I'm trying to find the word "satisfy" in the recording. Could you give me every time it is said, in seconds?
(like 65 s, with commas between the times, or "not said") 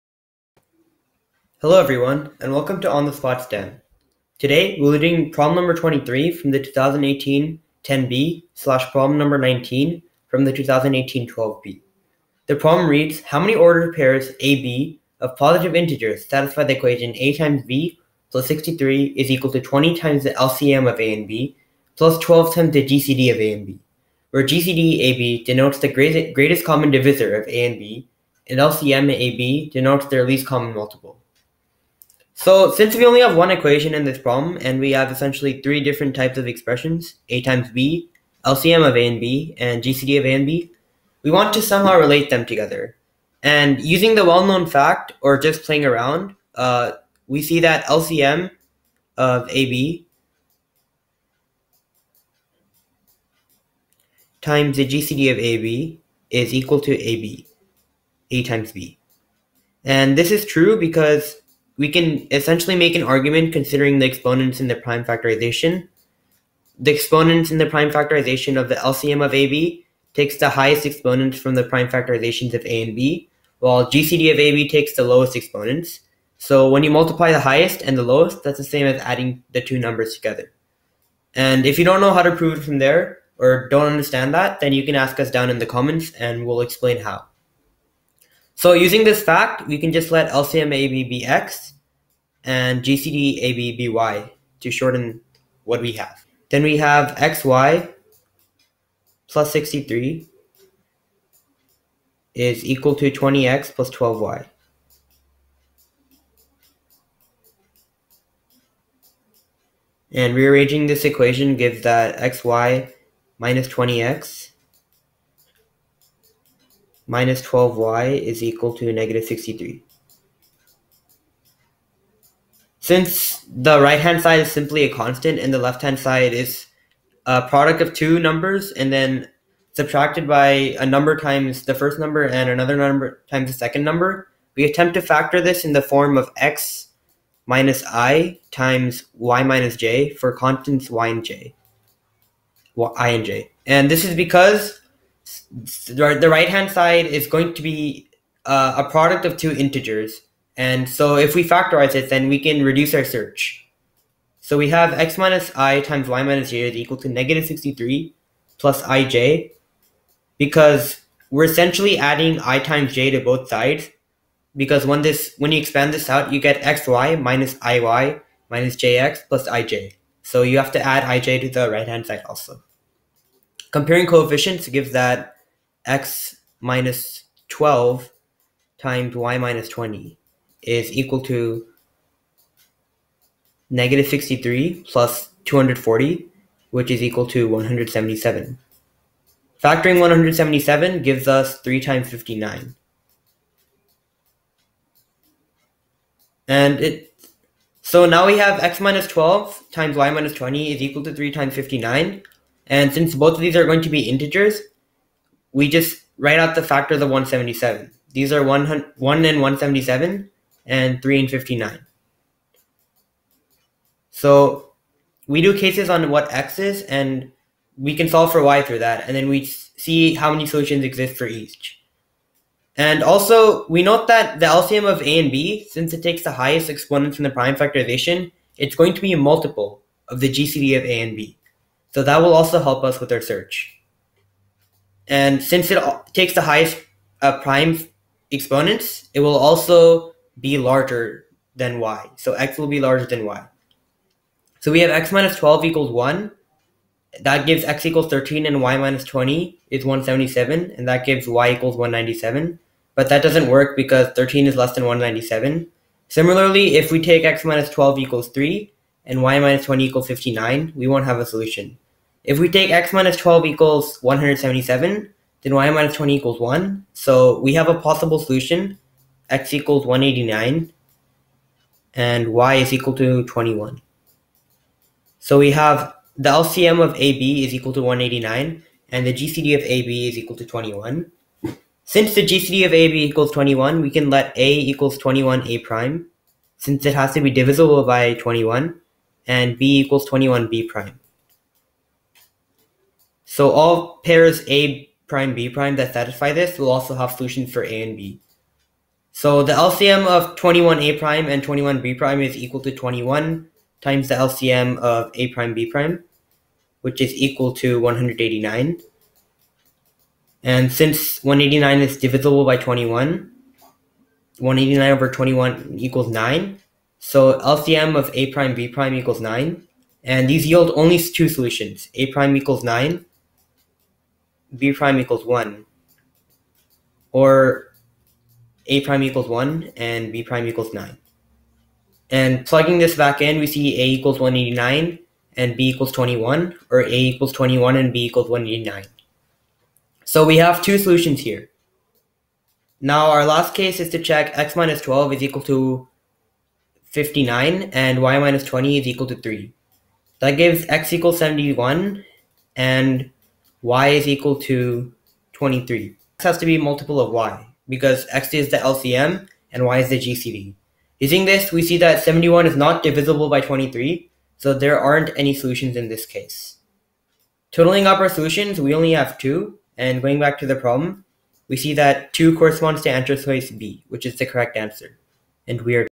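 16 s, 295 s.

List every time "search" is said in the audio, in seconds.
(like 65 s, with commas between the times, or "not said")
153 s, 233 s.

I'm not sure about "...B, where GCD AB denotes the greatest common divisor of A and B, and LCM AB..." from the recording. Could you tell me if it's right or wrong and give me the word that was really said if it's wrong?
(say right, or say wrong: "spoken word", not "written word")
right.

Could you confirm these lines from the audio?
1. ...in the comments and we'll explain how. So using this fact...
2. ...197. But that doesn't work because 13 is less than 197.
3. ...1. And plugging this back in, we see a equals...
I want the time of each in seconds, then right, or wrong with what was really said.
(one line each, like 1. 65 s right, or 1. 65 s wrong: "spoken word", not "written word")
1. 85 s right
2. 251 s right
3. 330 s wrong: "9", not "1".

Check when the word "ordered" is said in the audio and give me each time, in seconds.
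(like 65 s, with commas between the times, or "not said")
13 s.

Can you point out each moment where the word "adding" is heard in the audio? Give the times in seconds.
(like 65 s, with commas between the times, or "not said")
79 s, 161 s.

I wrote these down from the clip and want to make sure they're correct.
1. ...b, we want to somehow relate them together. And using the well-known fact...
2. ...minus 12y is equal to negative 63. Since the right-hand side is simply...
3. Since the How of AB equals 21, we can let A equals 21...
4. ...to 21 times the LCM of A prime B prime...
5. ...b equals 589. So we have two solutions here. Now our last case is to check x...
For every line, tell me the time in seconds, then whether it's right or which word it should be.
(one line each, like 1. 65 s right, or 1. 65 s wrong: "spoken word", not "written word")
1. 40 s right
2. 117 s right
3. 281 s wrong: "GCD", not "How"
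4. 302 s right
5. 337 s wrong: "189", not "589".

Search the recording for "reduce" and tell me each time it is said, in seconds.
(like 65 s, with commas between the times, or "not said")
152 s.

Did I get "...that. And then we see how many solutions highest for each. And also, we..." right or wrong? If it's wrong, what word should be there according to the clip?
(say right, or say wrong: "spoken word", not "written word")
wrong: "exist", not "highest".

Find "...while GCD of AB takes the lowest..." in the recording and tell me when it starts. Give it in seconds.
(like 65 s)
73 s.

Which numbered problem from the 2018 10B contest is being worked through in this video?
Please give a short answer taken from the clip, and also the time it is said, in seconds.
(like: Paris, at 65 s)
23, at 5 s.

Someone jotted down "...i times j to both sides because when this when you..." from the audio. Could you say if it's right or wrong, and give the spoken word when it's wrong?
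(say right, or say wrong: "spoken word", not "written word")
right.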